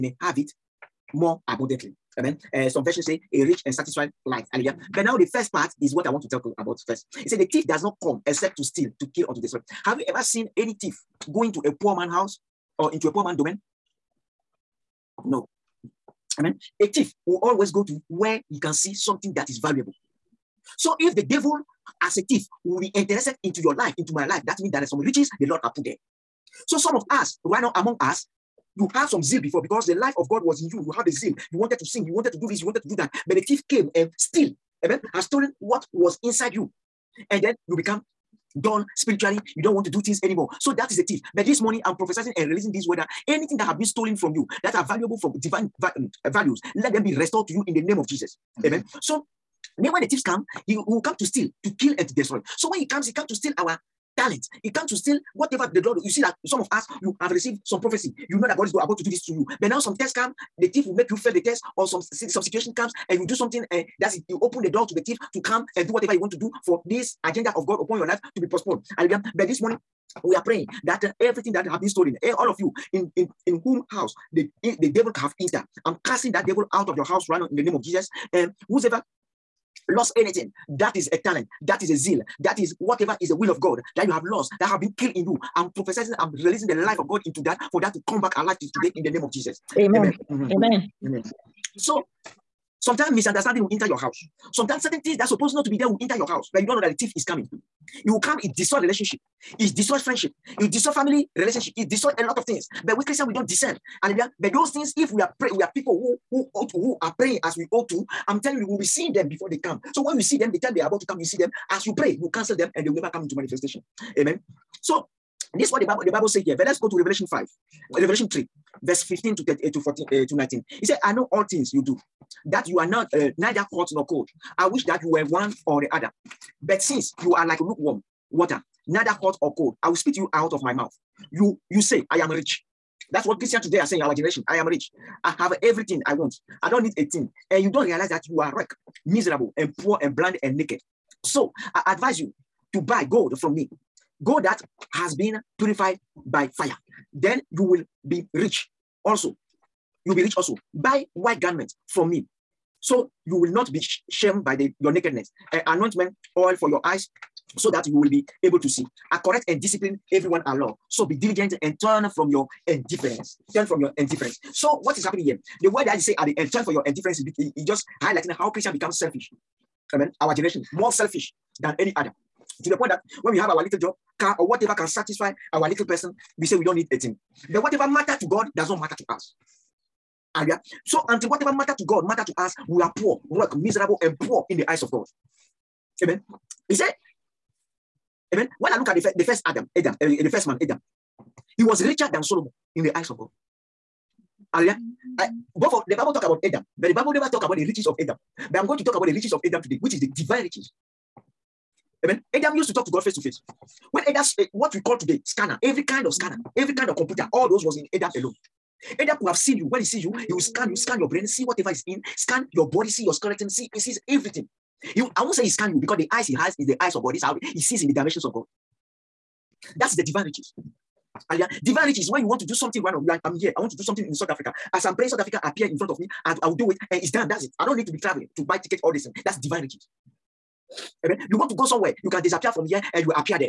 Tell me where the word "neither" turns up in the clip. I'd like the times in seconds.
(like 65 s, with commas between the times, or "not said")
123 s, 128 s.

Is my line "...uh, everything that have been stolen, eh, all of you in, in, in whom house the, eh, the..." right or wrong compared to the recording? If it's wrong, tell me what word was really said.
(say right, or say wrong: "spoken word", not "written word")
right.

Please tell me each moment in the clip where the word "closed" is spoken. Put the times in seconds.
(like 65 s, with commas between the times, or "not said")
not said.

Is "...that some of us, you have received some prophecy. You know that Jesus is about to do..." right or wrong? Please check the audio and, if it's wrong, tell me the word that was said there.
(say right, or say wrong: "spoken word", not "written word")
wrong: "God", not "Jesus".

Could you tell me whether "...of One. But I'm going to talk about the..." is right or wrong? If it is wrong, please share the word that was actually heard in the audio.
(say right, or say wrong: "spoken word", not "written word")
wrong: "Adam", not "One".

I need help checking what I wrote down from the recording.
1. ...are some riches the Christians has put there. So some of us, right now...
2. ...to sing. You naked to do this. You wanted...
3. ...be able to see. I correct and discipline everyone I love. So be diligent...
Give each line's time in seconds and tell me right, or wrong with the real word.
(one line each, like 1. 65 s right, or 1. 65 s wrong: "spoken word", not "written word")
1. 24 s wrong: "Lord", not "Christians"
2. 31 s wrong: "wanted", not "naked"
3. 158 s right.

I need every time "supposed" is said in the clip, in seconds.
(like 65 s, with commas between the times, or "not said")
95 s.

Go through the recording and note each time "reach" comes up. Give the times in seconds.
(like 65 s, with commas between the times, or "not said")
221 s.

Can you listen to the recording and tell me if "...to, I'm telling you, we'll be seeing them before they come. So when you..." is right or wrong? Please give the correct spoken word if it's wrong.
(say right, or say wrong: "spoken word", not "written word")
right.